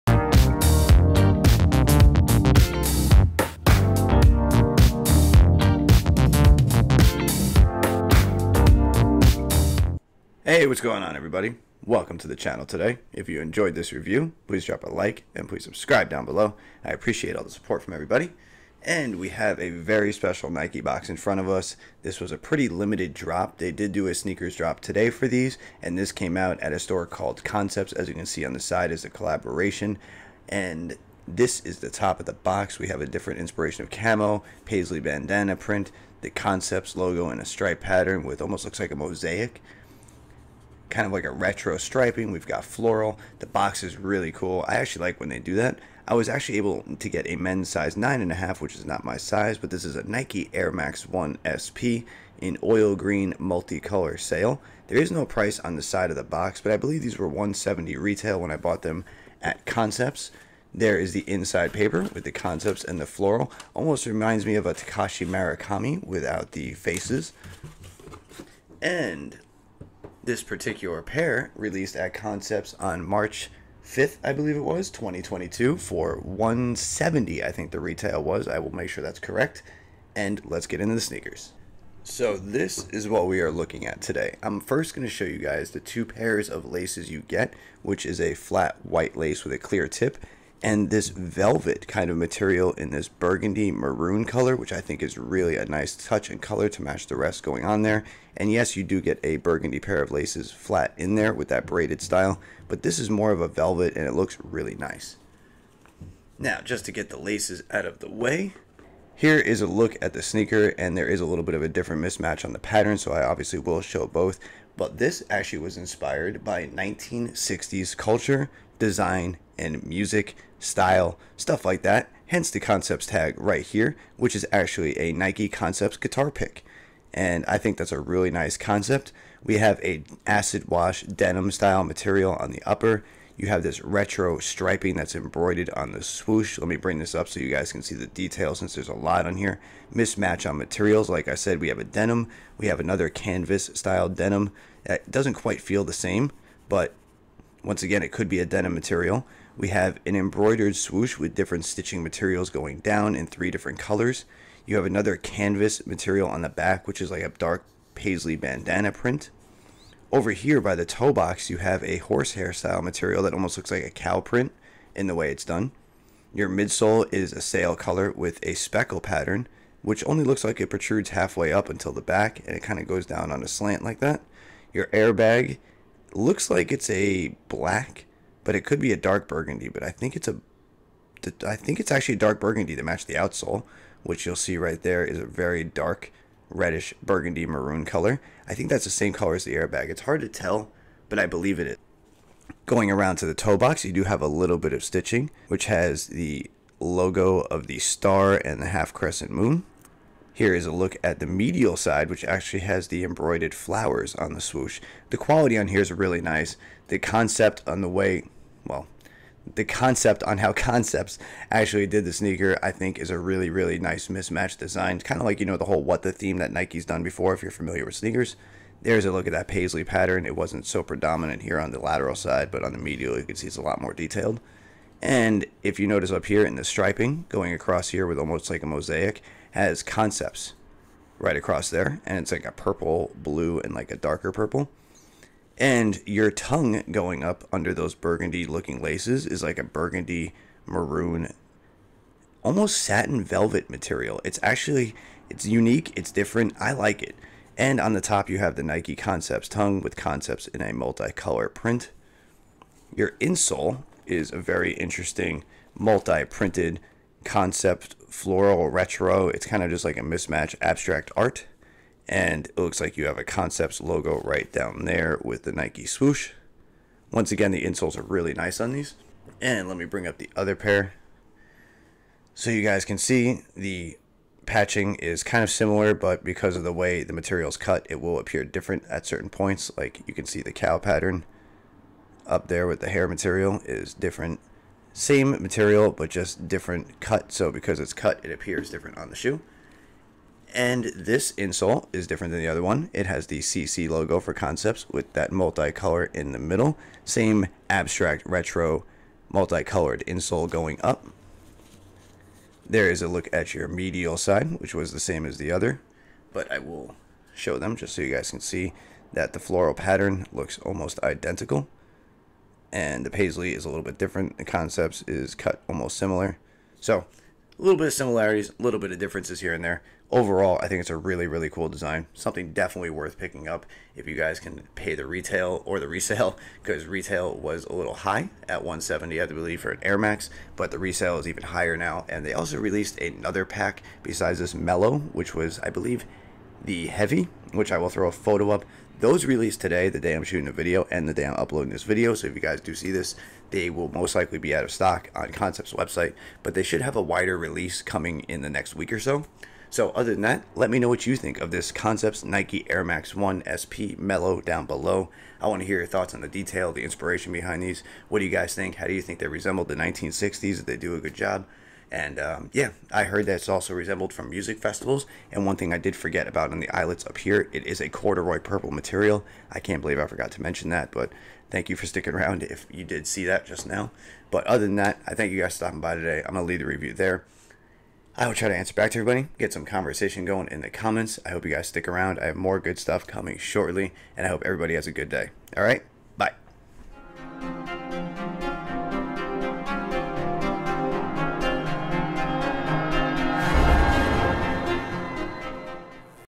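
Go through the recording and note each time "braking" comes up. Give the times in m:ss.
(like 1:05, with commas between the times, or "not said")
not said.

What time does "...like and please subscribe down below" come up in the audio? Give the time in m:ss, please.
0:14.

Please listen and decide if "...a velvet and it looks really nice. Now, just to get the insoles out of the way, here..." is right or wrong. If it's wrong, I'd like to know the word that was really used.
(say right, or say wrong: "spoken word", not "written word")
wrong: "laces", not "insoles".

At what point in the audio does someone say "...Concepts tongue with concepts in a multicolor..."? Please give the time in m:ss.
4:08.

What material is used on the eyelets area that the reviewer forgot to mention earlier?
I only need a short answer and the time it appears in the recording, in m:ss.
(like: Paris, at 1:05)
corduroy, at 6:07.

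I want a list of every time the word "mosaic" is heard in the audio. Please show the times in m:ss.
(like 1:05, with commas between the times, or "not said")
0:38, 3:48.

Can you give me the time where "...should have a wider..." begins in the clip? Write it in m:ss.
5:46.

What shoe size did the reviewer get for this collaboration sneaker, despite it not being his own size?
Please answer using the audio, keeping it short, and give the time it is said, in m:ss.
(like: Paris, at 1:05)
9.5, at 0:47.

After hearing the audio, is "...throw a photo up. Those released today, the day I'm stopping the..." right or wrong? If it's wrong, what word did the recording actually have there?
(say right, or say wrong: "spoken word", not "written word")
wrong: "shooting", not "stopping".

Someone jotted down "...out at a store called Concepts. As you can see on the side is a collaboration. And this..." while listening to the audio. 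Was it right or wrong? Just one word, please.
right.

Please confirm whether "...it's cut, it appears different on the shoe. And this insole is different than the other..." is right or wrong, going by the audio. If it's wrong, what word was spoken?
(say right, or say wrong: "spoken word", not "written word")
right.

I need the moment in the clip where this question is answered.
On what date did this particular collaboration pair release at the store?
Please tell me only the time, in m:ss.
1:13.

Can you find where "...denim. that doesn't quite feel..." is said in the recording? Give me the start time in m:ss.
2:24.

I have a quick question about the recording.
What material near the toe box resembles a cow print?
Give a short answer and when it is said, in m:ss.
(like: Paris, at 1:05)
horsehair, at 2:41.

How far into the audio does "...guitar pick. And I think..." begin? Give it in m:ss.
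2:05.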